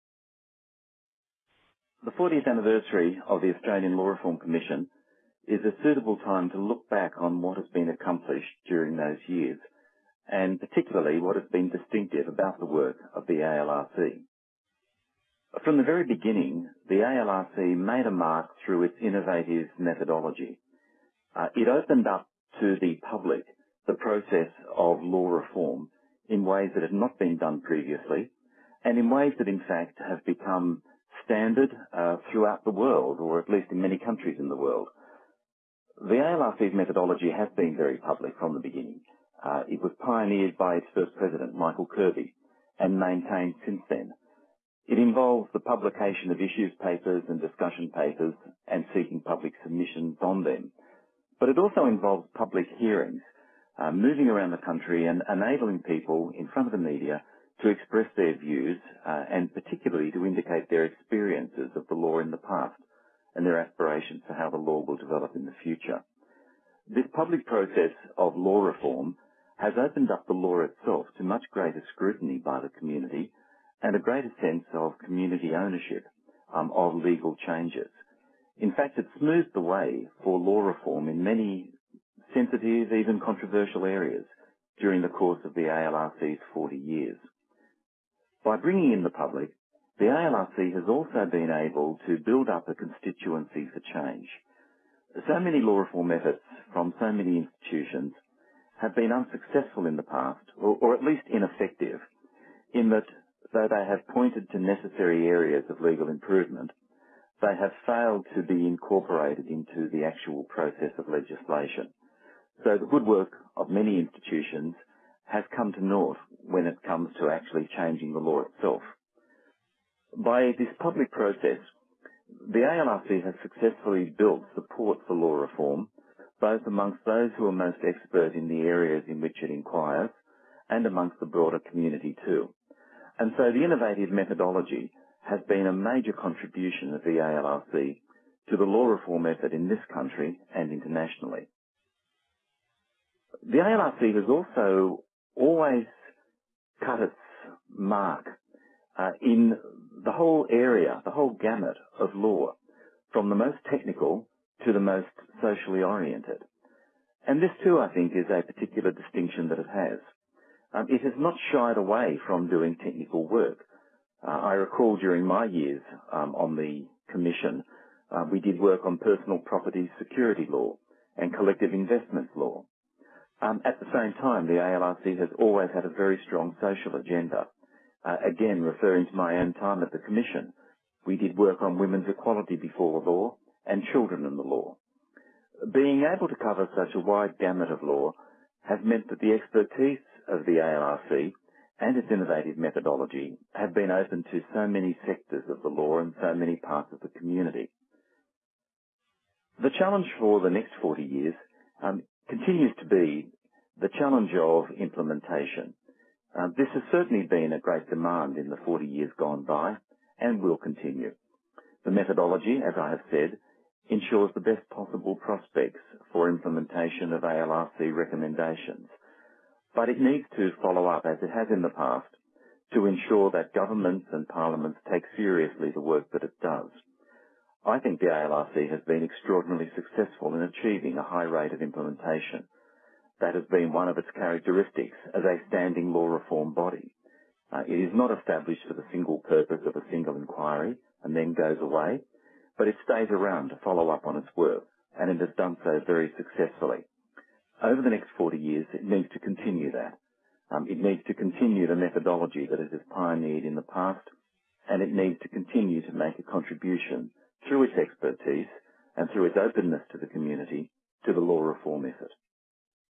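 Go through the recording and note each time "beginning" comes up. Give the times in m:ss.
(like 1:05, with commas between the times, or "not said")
0:16, 0:38.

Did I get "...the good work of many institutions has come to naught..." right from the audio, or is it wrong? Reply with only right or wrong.
right.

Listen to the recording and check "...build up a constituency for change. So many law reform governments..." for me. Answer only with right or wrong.
wrong.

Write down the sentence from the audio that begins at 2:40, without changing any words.
Um, it has not shied away from doing technical work.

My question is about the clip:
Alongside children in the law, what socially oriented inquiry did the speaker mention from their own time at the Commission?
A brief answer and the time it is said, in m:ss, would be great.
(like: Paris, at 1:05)
Women's equality before the law, at 3:01.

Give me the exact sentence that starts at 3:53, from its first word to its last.
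That has been one of its characteristics as a standing law reform body.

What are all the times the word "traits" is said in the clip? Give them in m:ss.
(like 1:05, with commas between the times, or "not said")
not said.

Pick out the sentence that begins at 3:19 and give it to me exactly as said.
The challenge for the next 40 years um, continues to be the challenge of implementation.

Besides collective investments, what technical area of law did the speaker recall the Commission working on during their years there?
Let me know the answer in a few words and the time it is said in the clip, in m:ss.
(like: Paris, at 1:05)
Personal property security law, at 2:48.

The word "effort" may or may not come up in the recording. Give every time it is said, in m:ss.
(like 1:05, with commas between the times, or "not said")
1:36, 2:19, 4:21.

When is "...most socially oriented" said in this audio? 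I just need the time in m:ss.
2:34.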